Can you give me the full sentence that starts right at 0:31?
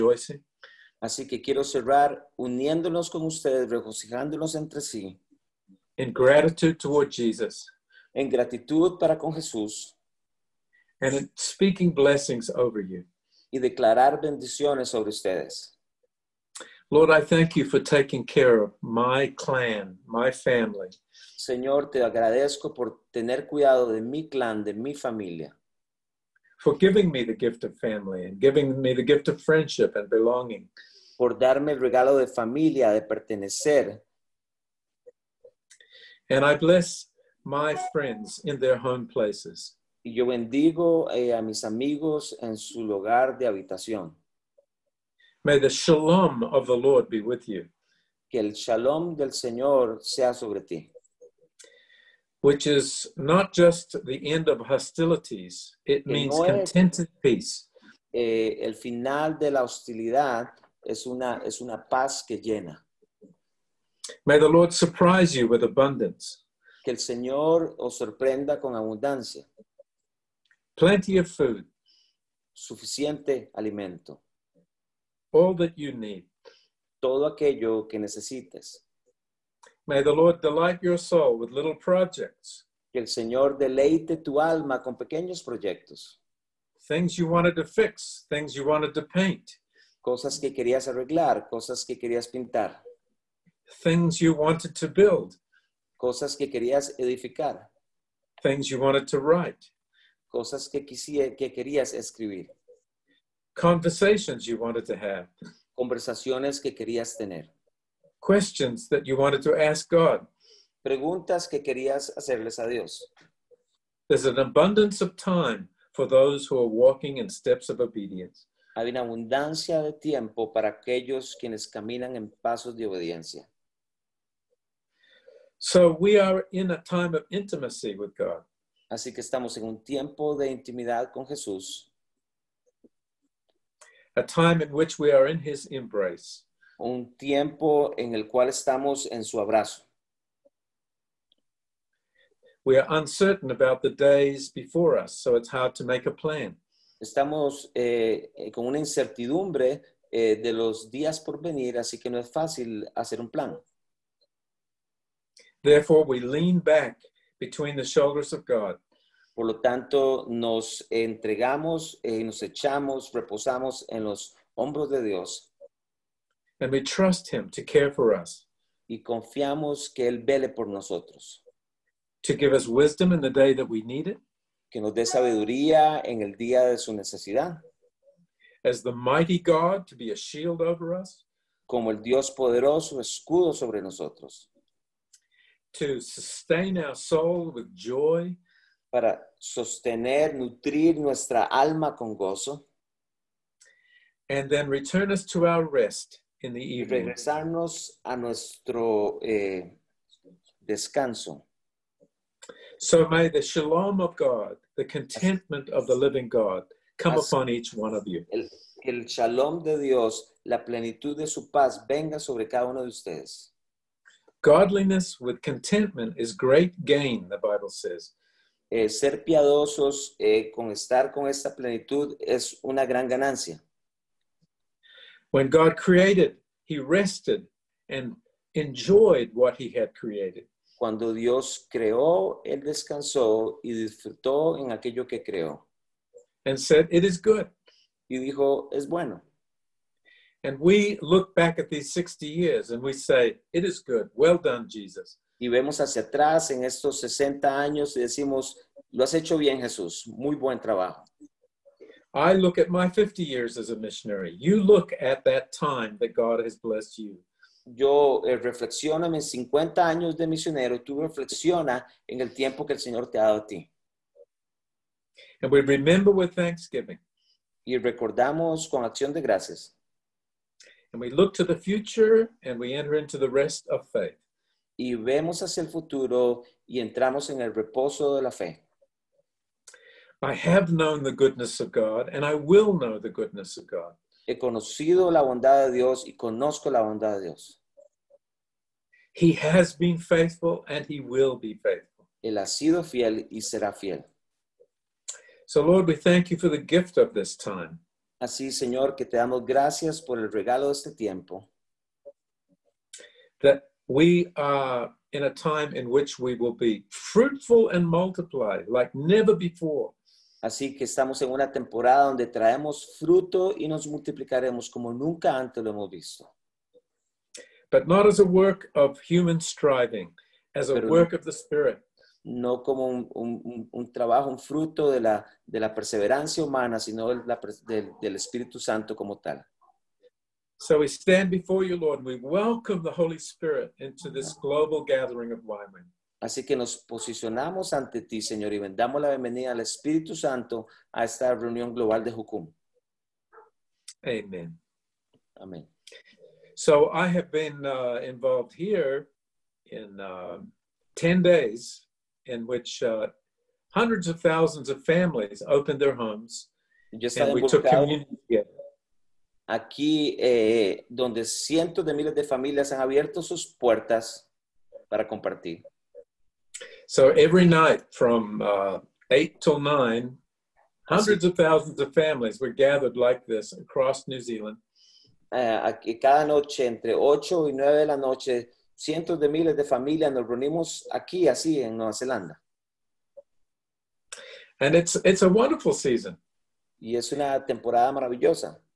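por darme el regalo de familia, de pertenecer and I bless my friends in their home places.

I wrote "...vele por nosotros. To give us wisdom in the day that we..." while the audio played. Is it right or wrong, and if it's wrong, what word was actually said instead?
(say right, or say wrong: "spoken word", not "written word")
right.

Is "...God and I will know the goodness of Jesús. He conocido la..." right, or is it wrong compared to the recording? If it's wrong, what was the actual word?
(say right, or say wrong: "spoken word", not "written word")
wrong: "God", not "Jesús".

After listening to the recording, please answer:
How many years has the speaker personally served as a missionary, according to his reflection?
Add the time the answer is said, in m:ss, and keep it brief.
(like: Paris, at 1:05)
50, at 4:12.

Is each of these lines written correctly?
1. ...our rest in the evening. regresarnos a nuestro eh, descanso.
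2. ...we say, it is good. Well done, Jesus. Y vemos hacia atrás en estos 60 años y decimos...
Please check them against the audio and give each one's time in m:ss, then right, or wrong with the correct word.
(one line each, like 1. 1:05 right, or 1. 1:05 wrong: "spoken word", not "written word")
1. 3:15 right
2. 4:02 right.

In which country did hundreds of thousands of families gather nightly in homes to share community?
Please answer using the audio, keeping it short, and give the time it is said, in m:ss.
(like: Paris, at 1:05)
New Zealand, at 6:14.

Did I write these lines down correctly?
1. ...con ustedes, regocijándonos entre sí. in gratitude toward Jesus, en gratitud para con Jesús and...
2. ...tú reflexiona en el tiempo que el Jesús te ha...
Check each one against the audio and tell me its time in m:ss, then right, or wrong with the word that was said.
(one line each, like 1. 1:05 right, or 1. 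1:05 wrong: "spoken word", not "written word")
1. 0:03 right
2. 4:20 wrong: "Señor", not "Jesús".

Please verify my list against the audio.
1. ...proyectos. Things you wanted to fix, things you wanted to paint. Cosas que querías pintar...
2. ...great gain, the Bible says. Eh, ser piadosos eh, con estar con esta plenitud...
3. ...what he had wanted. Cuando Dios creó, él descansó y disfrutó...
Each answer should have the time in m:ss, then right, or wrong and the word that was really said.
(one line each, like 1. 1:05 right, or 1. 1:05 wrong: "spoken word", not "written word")
1. 1:25 wrong: "arreglar", not "pintar"
2. 3:36 right
3. 3:49 wrong: "created", not "wanted".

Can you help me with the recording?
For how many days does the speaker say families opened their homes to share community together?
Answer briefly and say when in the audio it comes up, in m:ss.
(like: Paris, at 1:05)
10, at 5:50.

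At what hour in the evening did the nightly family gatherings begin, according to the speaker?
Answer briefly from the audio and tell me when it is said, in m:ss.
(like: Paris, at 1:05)
8, at 6:09.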